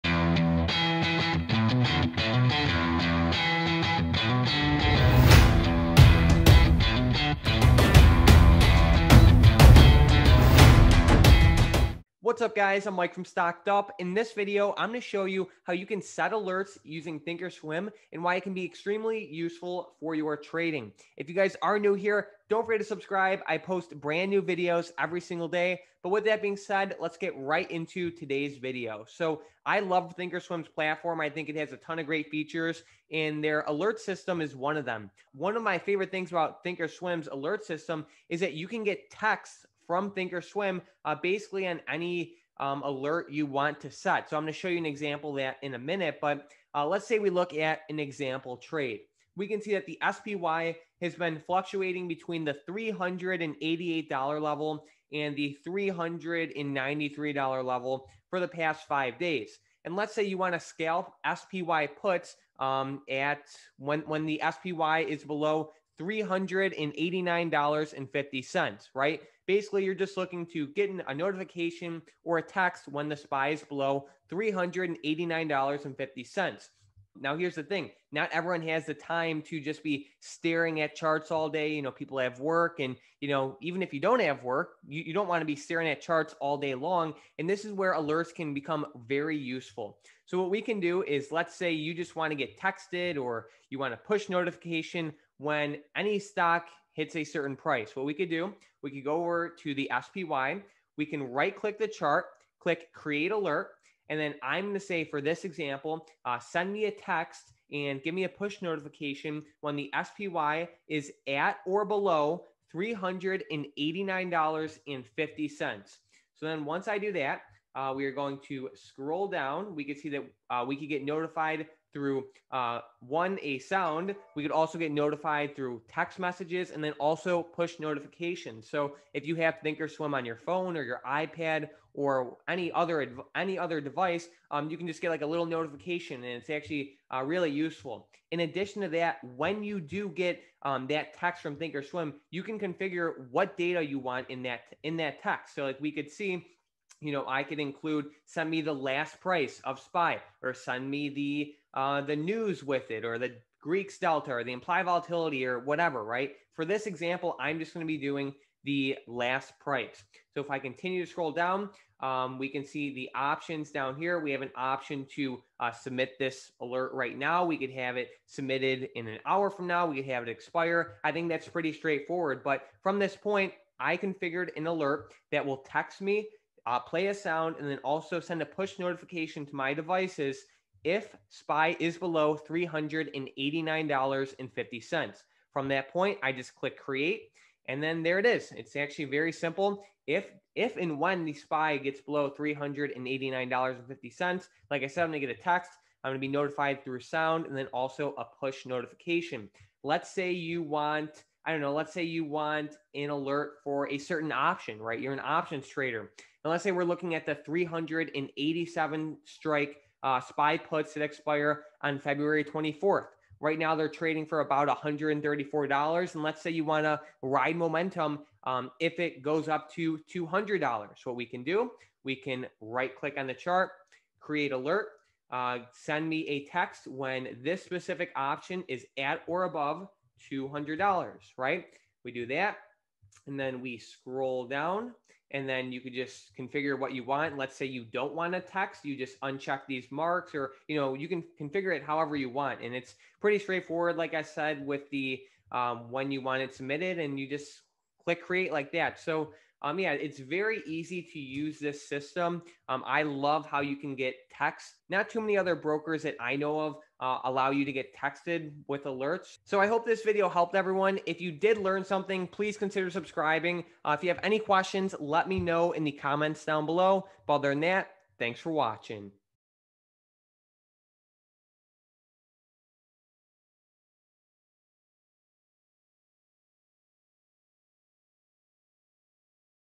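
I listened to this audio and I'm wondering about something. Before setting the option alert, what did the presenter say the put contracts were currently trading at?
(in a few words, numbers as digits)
$134.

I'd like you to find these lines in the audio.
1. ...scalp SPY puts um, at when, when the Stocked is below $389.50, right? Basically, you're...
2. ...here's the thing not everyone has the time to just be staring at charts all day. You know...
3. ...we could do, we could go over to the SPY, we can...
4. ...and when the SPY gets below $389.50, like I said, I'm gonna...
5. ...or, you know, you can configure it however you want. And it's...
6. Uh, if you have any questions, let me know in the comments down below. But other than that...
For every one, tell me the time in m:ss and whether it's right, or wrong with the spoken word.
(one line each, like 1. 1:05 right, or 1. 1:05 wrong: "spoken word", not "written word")
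1. 1:00 wrong: "SPY", not "Stocked"
2. 1:17 right
3. 1:38 right
4. 3:10 right
5. 4:00 right
6. 4:23 right.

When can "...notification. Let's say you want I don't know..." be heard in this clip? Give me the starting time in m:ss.
3:18.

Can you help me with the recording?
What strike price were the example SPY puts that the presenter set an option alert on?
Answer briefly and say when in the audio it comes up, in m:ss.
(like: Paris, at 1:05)
387, at 3:27.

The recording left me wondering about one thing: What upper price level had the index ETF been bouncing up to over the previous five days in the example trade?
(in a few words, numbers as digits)
$393.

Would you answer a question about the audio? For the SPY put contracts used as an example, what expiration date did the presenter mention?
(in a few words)
February 24th.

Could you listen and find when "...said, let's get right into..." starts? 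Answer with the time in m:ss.
0:26.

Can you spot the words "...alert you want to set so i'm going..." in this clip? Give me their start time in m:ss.
0:42.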